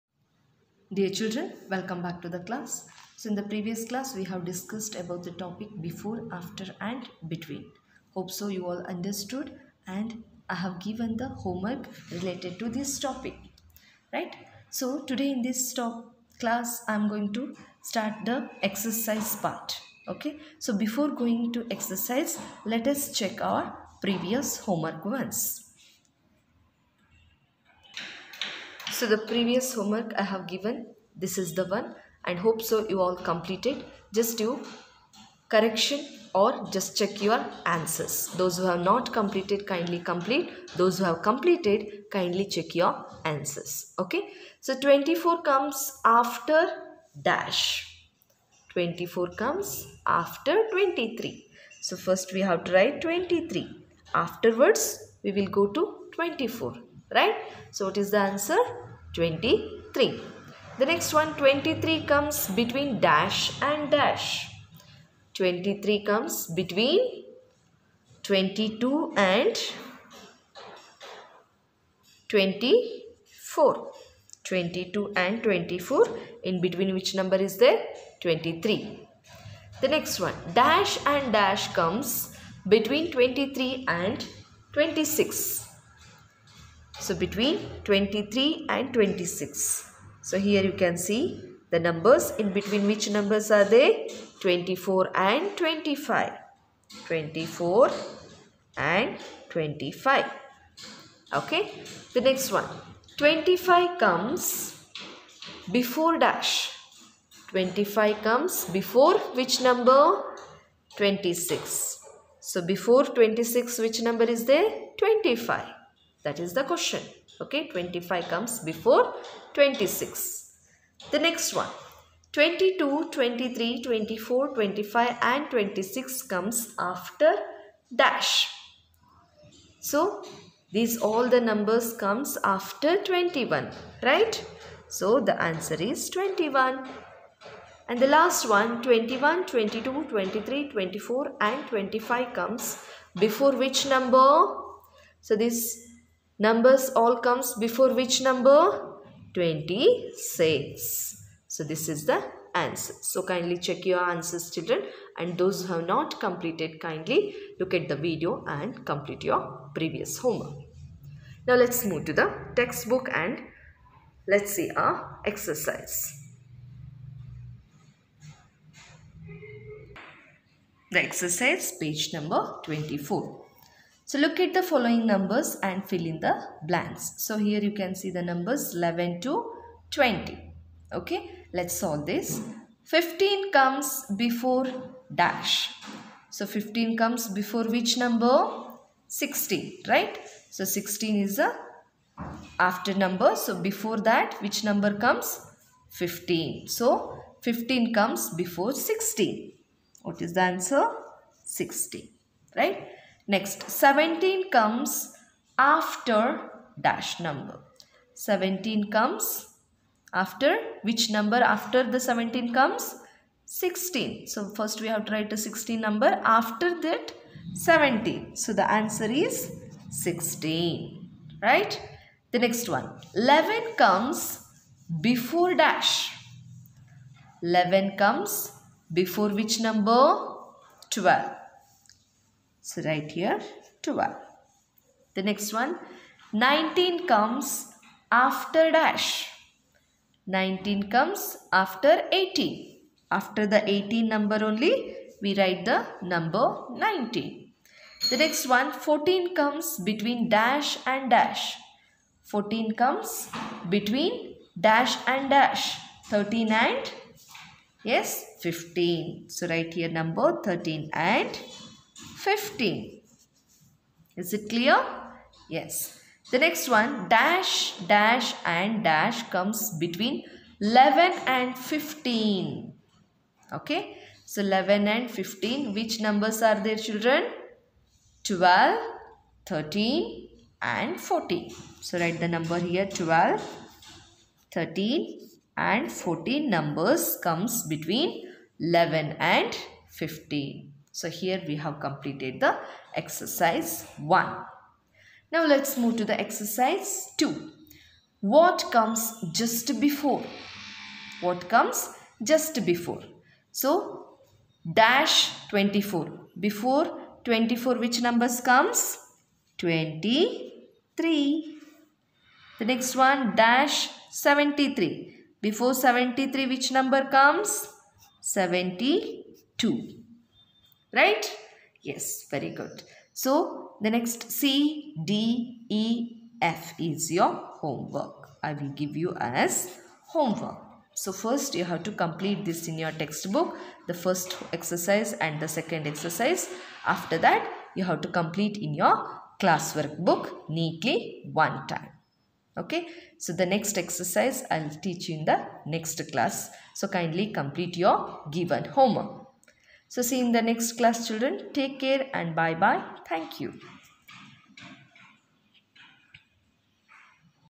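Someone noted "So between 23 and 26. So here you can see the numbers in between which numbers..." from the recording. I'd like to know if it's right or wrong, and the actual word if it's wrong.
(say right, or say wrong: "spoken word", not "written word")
right.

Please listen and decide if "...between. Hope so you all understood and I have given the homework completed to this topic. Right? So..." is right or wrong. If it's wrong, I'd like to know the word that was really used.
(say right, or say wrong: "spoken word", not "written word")
wrong: "related", not "completed".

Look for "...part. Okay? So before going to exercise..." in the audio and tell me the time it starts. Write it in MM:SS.
00:19.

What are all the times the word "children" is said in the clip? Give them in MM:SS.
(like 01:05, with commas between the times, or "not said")
00:01, 02:34, 04:36, 05:51.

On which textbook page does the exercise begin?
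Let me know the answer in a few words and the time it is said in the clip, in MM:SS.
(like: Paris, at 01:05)
24, at 02:51.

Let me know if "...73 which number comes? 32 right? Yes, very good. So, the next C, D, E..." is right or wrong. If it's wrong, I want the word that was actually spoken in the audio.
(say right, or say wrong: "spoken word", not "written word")
wrong: "72", not "32".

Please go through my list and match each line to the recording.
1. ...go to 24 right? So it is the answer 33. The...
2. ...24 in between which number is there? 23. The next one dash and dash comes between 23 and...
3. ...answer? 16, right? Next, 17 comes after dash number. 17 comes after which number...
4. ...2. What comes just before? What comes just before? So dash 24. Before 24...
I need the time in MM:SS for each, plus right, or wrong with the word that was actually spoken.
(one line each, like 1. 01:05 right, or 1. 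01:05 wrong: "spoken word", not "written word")
1. 00:55 wrong: "23", not "33"
2. 01:15 right
3. 03:20 right
4. 04:57 right.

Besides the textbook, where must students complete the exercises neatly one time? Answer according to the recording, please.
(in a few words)
class workbook.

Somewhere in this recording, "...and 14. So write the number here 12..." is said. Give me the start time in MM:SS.
04:40.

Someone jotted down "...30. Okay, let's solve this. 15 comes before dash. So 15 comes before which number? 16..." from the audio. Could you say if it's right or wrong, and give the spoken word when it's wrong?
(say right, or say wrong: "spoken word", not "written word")
wrong: "20", not "30".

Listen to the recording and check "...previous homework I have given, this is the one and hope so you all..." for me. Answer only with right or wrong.
right.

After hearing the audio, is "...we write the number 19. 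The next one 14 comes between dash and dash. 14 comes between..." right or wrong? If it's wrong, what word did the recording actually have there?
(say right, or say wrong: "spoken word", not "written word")
right.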